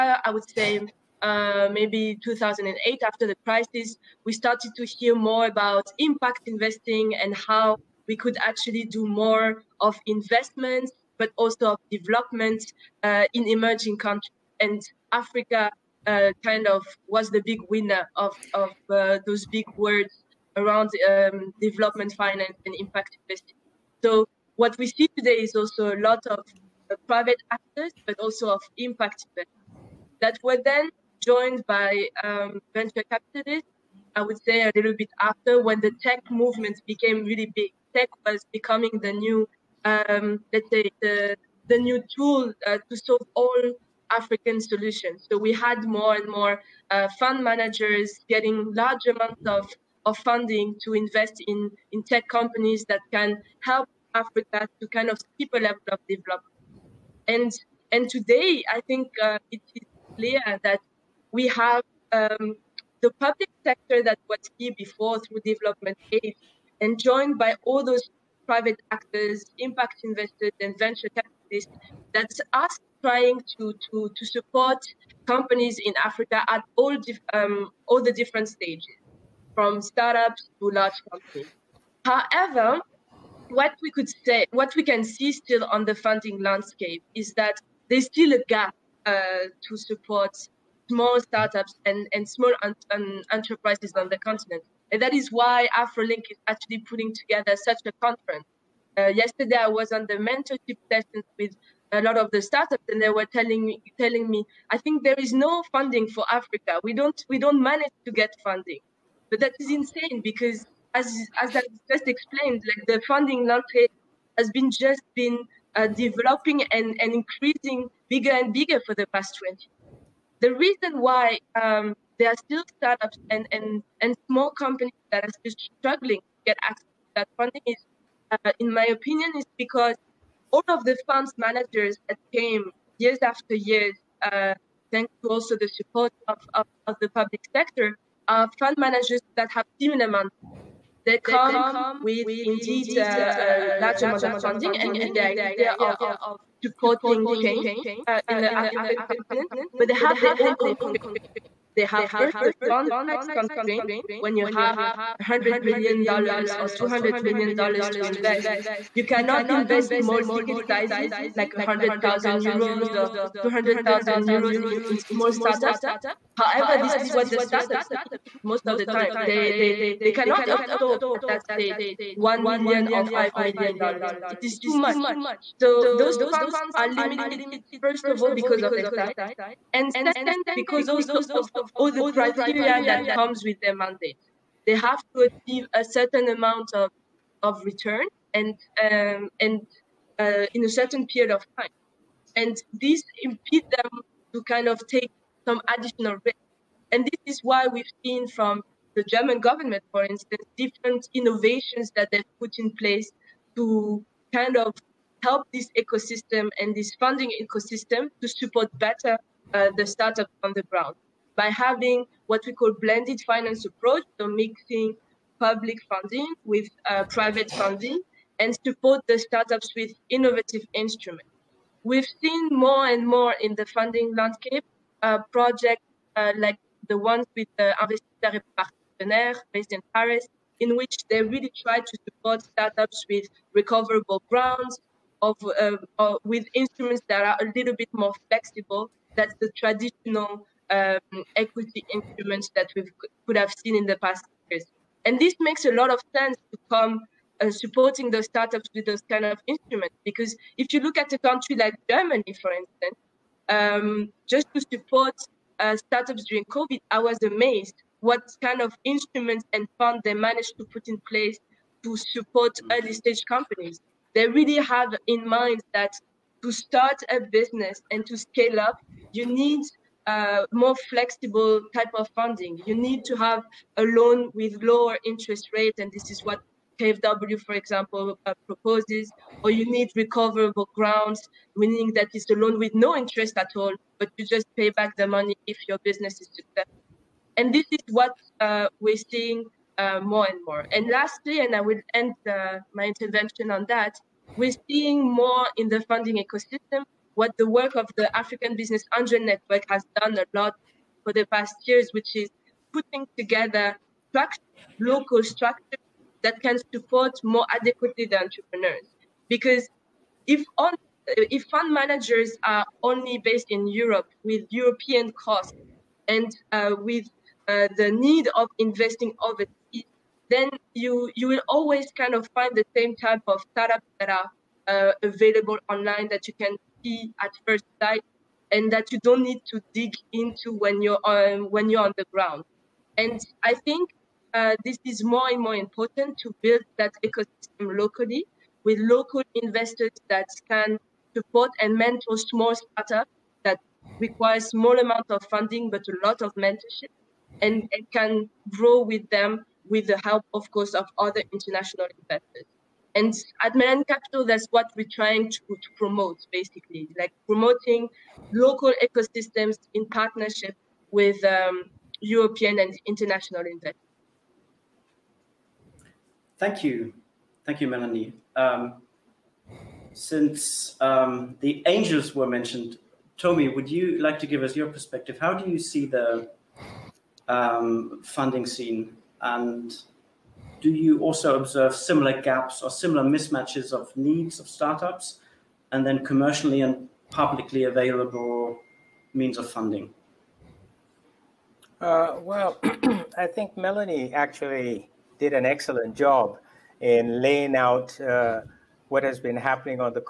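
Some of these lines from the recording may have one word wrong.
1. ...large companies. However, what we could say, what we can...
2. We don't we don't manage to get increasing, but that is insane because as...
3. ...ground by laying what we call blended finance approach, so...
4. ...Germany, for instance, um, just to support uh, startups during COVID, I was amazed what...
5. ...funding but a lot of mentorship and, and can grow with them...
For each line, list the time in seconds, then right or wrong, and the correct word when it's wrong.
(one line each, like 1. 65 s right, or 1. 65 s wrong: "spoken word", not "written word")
1. 80 s right
2. 106 s wrong: "funding", not "increasing"
3. 210 s wrong: "having", not "laying"
4. 251 s right
5. 345 s right.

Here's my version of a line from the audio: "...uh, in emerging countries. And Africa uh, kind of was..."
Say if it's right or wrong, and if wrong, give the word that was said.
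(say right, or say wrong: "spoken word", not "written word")
right.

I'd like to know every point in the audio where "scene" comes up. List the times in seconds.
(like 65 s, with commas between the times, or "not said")
378 s.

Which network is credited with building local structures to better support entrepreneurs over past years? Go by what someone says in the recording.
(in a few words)
African Business Angel Network.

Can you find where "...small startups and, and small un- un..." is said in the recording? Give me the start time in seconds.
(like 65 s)
90 s.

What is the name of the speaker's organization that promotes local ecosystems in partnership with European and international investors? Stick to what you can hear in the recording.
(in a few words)
Melanin Kapital.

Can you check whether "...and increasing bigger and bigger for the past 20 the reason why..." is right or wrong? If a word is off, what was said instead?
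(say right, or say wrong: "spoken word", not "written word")
right.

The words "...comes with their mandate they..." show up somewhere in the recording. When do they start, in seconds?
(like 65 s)
183 s.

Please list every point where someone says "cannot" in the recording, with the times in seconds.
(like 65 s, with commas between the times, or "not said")
159 s, 170 s.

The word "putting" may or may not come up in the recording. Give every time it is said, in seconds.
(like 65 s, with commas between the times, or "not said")
96 s, 302 s.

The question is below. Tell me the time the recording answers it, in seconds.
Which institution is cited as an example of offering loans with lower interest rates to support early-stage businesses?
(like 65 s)
276 s.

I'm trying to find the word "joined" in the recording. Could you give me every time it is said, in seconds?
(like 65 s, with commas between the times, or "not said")
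31 s, 67 s.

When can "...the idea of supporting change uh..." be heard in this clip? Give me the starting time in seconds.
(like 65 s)
145 s.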